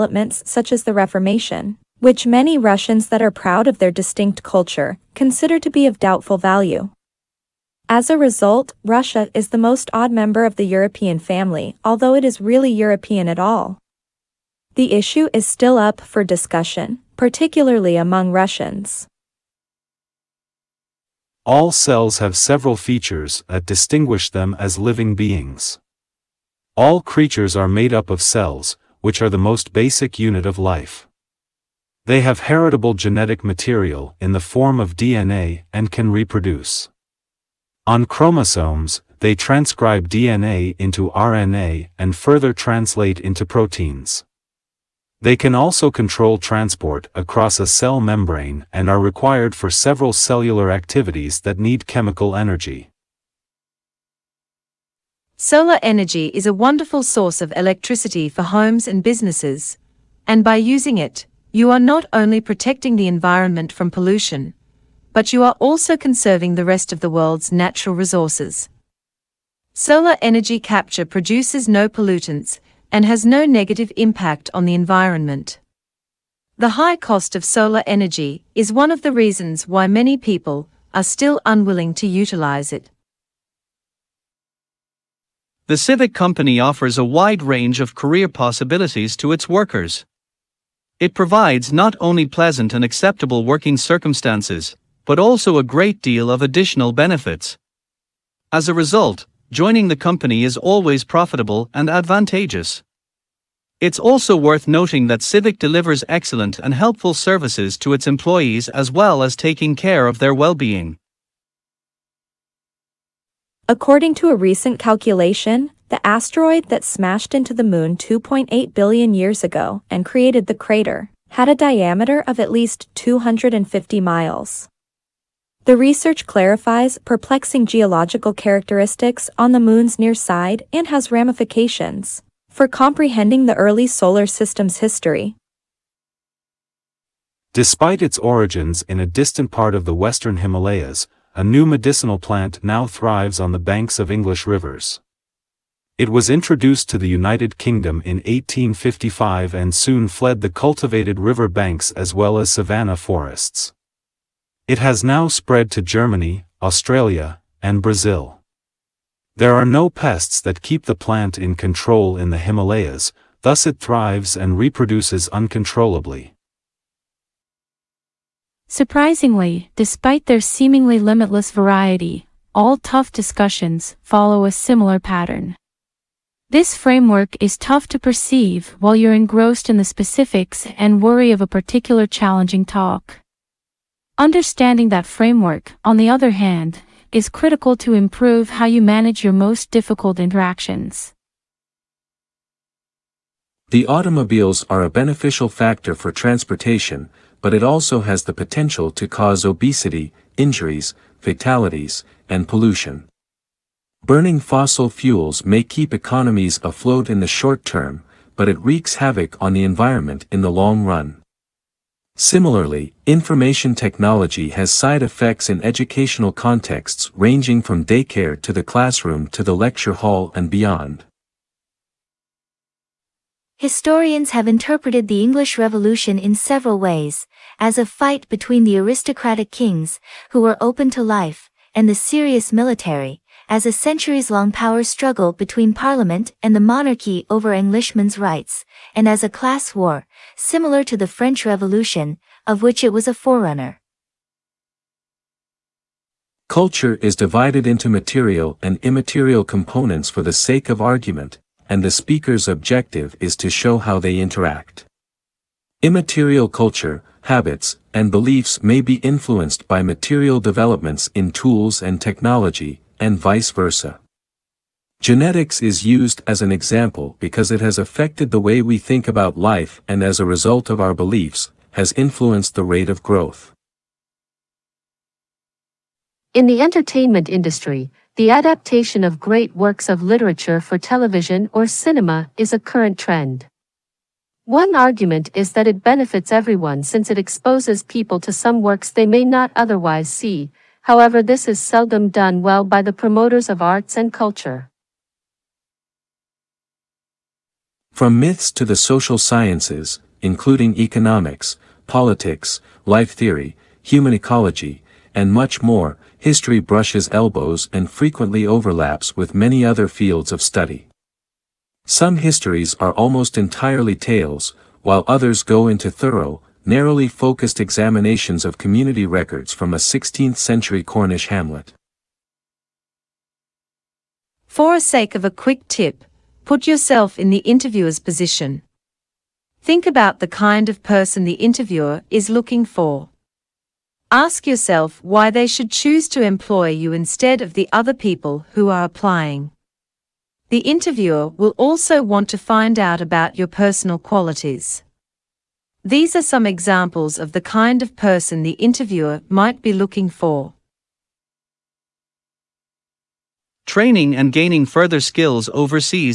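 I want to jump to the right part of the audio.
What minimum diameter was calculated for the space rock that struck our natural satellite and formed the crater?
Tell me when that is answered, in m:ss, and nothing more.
2:02.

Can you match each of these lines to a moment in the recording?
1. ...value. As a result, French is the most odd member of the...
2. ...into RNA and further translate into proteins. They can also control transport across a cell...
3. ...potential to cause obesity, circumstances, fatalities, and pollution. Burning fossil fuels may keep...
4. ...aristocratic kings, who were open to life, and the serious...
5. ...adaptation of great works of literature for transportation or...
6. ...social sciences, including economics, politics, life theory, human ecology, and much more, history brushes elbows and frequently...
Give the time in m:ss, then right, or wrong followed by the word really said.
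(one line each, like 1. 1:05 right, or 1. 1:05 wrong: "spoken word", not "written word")
1. 0:06 wrong: "Russia", not "French"
2. 0:40 right
3. 3:18 wrong: "injuries", not "circumstances"
4. 3:48 right
5. 4:38 wrong: "television", not "transportation"
6. 4:58 right.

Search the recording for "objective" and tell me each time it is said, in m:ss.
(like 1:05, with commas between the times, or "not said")
4:12.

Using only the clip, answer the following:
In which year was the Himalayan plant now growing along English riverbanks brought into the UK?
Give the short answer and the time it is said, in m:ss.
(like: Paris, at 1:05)
1855, at 2:28.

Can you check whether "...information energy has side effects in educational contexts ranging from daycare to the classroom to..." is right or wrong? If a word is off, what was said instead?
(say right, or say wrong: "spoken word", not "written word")
wrong: "technology", not "energy".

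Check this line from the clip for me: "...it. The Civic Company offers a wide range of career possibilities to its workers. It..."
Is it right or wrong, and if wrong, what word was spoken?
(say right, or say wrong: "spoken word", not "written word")
right.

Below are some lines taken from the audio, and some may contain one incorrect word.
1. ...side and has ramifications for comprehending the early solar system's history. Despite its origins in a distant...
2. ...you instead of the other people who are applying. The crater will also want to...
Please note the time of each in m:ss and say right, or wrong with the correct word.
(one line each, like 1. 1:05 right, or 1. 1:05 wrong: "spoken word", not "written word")
1. 2:10 right
2. 5:36 wrong: "interviewer", not "crater".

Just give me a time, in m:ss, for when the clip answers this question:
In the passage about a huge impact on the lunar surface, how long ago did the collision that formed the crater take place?
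1:57.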